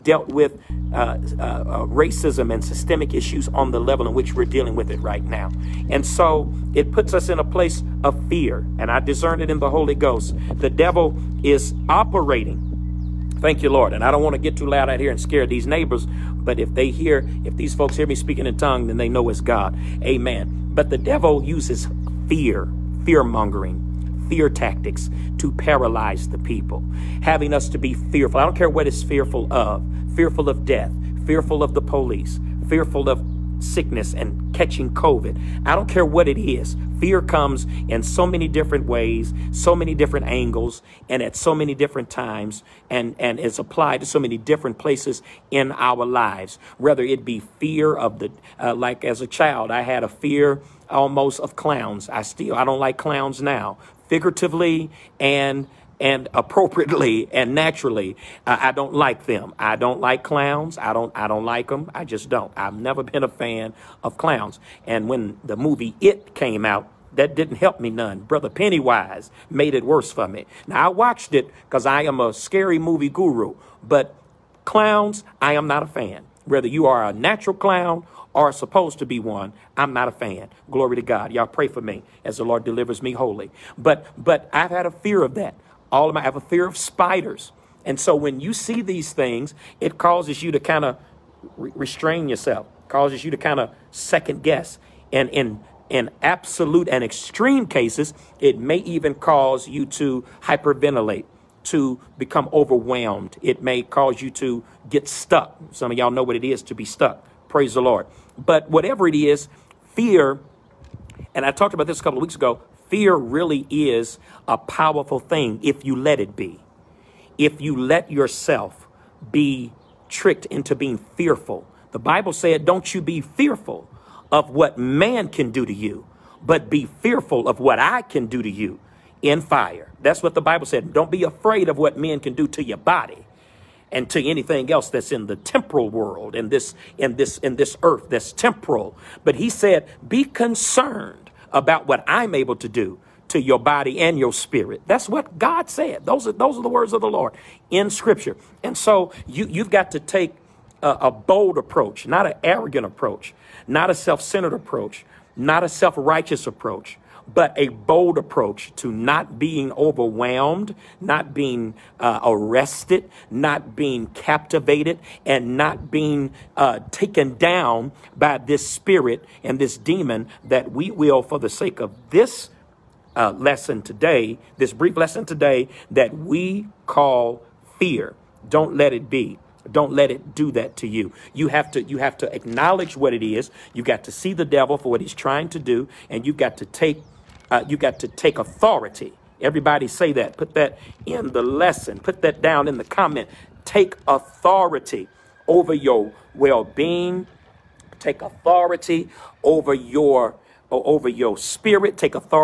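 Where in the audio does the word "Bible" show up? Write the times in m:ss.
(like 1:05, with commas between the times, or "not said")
2:01, 2:10.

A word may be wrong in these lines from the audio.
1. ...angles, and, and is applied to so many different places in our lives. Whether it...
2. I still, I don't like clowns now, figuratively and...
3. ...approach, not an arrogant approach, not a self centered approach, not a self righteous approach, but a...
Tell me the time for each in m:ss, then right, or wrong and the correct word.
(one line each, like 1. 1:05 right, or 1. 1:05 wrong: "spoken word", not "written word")
1. 0:42 wrong: "times", not "angles"
2. 0:52 right
3. 2:31 right.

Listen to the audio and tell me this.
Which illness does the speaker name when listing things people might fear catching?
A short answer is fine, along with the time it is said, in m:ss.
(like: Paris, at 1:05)
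COVID, at 0:34.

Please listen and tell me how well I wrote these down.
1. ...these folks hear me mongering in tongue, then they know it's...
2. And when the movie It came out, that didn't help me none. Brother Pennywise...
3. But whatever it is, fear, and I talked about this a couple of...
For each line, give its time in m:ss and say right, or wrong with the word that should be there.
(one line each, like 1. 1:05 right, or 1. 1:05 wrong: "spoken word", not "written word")
1. 0:17 wrong: "speaking", not "mongering"
2. 1:04 right
3. 1:48 right.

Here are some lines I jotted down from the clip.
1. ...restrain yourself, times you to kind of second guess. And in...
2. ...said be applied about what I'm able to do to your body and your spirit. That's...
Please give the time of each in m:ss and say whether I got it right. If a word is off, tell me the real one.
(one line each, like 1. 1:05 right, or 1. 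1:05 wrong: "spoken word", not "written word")
1. 1:31 wrong: "causes", not "times"
2. 2:19 wrong: "concerned", not "applied".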